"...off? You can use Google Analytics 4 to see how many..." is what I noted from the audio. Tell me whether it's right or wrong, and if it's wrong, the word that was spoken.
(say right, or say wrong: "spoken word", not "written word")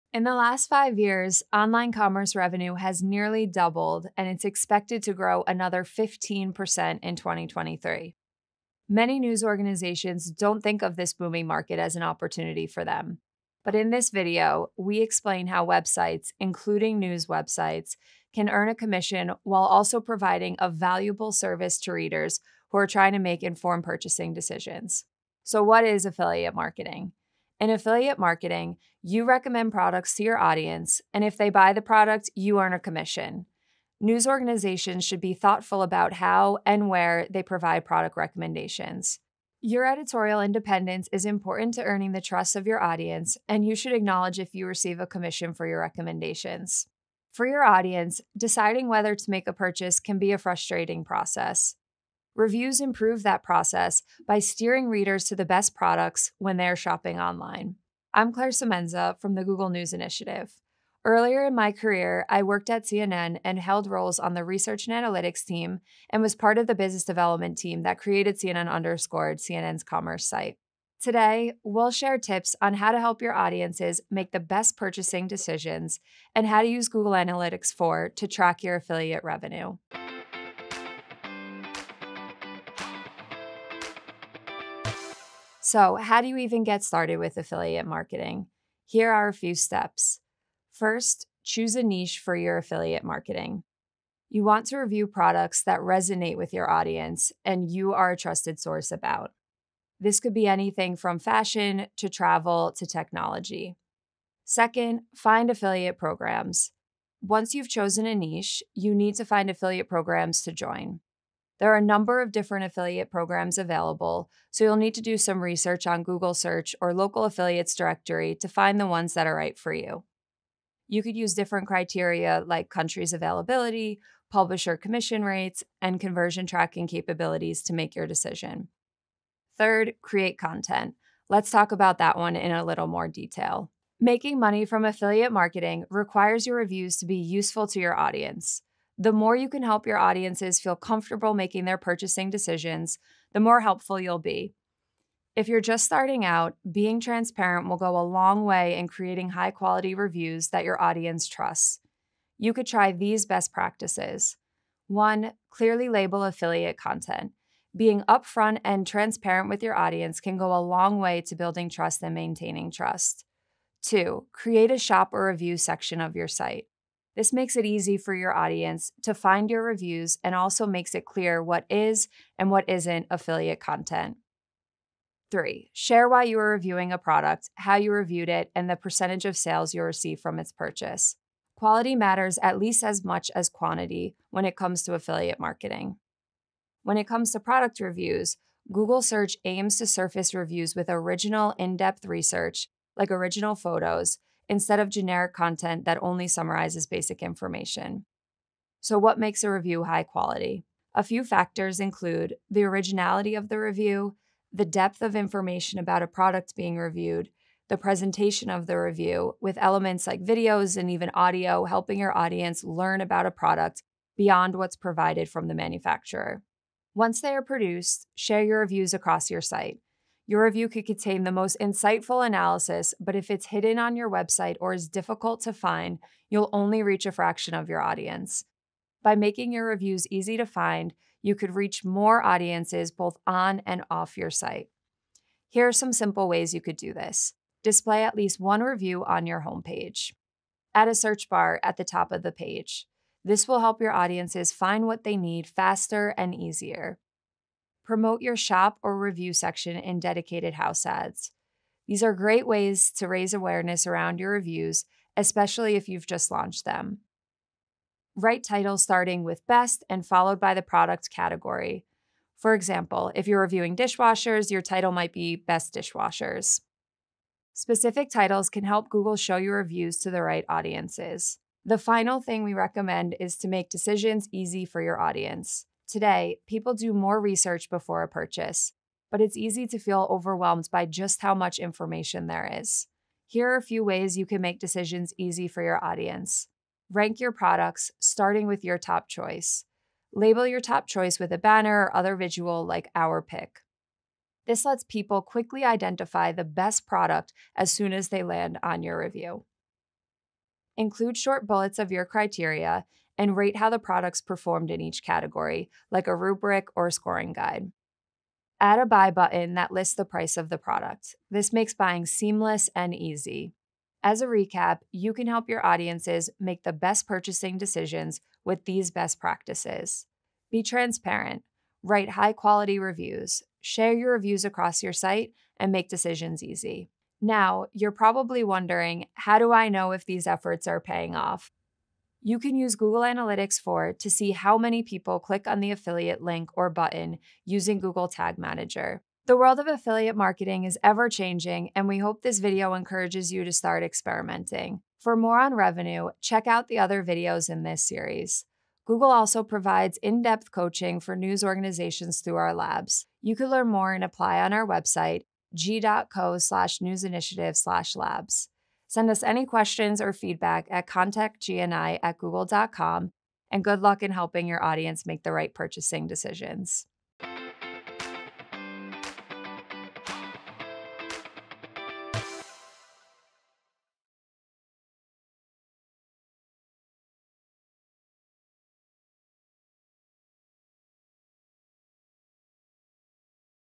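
right.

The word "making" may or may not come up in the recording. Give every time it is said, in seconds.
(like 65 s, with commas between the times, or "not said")
133 s, 141 s, 229 s.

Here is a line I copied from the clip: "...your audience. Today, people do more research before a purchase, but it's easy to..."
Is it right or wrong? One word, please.
right.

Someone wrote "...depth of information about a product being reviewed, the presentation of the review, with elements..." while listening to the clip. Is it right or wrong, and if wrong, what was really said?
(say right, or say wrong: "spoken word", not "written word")
right.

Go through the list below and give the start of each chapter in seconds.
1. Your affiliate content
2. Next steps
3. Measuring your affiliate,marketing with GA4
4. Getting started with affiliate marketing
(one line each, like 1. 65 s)
1. 134 s
2. 339 s
3. 327 s
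4. 86 s.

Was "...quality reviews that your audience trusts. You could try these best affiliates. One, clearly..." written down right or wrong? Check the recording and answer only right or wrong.
wrong.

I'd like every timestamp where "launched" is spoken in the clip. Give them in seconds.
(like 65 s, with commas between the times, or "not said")
256 s.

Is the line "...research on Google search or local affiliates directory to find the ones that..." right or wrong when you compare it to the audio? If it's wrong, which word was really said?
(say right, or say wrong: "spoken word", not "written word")
right.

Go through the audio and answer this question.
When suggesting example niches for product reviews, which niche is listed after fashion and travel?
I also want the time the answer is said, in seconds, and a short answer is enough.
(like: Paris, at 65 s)
technology, at 102 s.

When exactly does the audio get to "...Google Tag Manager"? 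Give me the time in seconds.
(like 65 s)
337 s.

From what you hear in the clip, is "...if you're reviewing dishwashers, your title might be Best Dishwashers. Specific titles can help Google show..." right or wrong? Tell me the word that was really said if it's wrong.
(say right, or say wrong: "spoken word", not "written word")
right.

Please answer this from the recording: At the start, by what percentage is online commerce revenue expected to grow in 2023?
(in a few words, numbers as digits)
15%.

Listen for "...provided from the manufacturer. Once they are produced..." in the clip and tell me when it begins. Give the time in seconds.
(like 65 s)
214 s.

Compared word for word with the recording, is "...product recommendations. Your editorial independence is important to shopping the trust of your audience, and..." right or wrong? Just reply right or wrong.
wrong.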